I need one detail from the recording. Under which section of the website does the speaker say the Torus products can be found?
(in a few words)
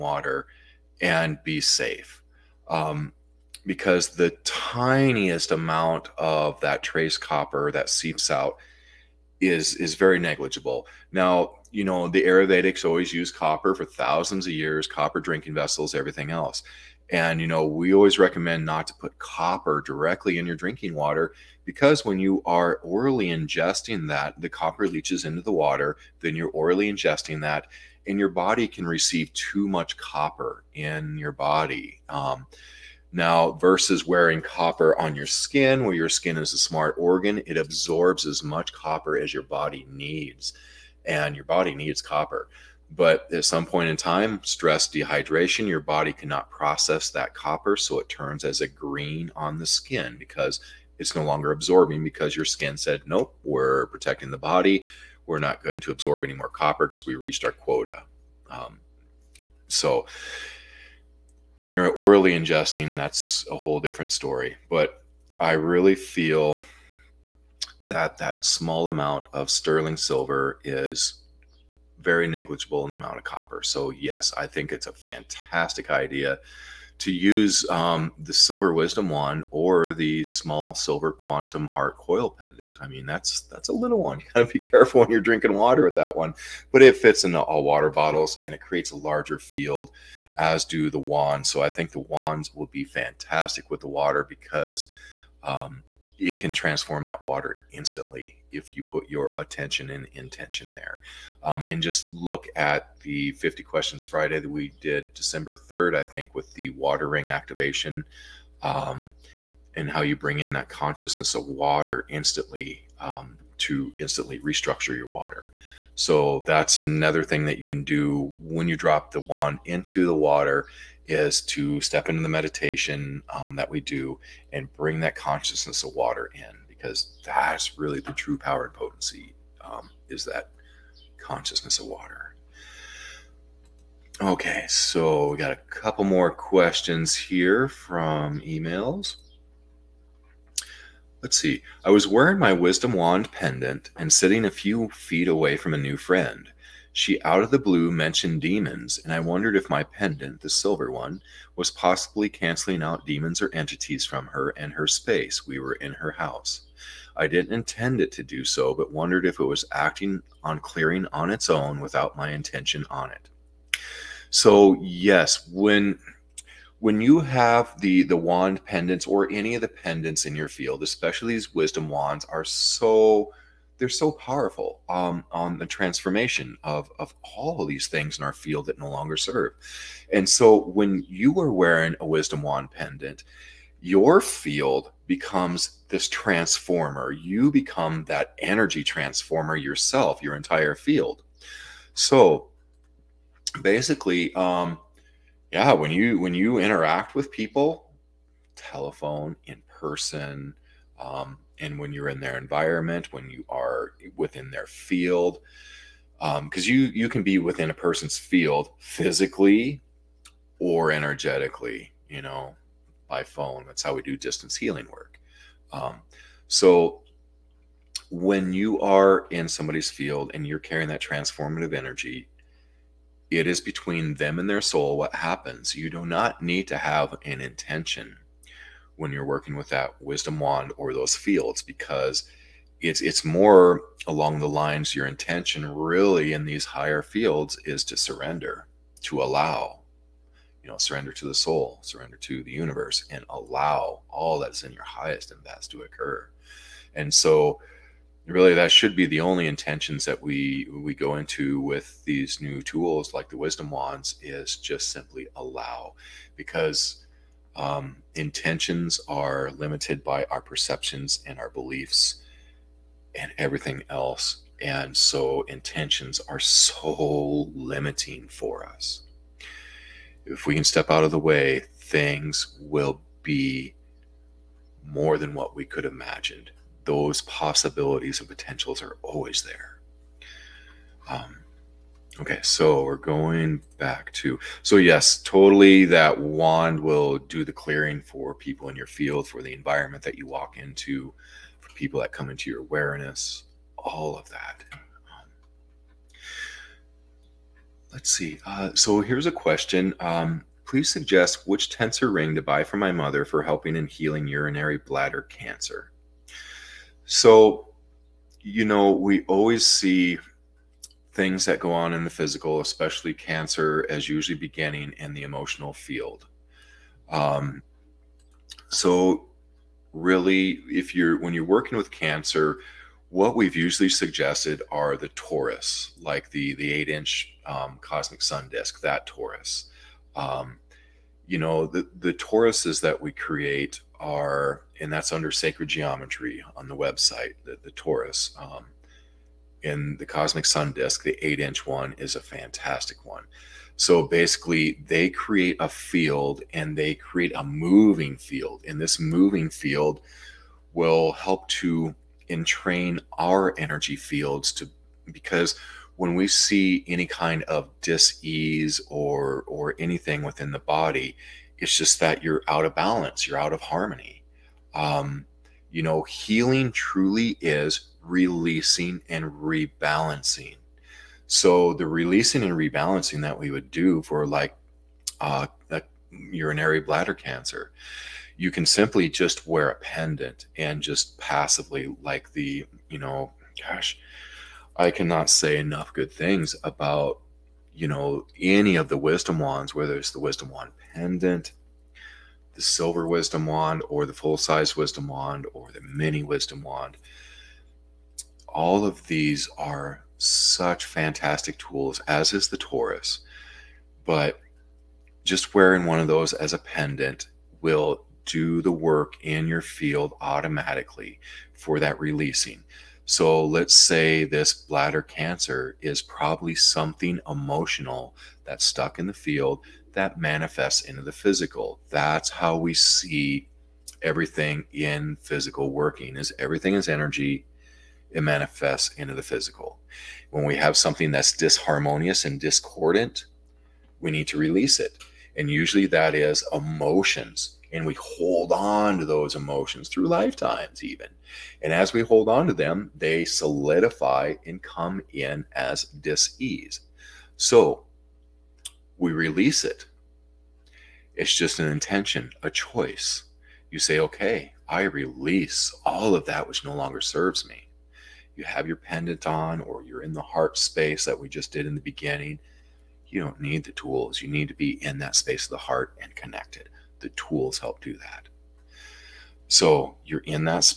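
sacred geometry.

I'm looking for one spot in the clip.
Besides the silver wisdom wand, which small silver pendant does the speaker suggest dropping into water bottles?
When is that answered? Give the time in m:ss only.
1:21.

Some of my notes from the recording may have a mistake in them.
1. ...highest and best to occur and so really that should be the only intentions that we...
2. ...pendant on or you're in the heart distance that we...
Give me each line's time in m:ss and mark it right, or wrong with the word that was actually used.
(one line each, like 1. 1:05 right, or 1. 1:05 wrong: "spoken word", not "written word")
1. 4:04 right
2. 7:38 wrong: "space", not "distance".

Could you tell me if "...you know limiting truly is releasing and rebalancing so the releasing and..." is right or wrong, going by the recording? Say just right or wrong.
wrong.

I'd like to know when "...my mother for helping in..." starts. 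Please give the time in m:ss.
5:02.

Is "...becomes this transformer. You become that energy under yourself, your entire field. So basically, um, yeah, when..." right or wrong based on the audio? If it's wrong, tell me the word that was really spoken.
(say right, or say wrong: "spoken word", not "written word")
wrong: "transformer", not "under".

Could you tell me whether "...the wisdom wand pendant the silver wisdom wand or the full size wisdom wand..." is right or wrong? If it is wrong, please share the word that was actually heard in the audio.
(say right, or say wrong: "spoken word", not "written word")
right.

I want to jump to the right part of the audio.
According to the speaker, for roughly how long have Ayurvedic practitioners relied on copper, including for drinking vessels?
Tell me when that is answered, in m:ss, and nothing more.
0:13.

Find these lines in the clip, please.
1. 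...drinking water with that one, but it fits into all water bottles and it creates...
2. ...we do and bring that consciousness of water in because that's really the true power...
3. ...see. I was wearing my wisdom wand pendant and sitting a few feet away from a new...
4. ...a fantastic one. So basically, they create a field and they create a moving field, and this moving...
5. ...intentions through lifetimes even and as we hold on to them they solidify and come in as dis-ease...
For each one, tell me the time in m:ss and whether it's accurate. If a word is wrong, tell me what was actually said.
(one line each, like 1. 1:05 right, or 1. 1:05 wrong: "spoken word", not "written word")
1. 1:25 right
2. 2:03 right
3. 2:21 right
4. 5:42 right
5. 7:19 wrong: "emotions", not "intentions".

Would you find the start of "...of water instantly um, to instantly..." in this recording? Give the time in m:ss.
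1:51.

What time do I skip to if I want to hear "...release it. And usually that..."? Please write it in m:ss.
7:14.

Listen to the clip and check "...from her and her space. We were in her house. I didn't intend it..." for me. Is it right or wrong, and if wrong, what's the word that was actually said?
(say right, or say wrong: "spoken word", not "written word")
right.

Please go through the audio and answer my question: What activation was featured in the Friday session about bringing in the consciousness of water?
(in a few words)
water ring activation.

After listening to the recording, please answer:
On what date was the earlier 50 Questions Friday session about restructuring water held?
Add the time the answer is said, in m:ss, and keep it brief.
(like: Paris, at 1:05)
December 3rd, at 1:45.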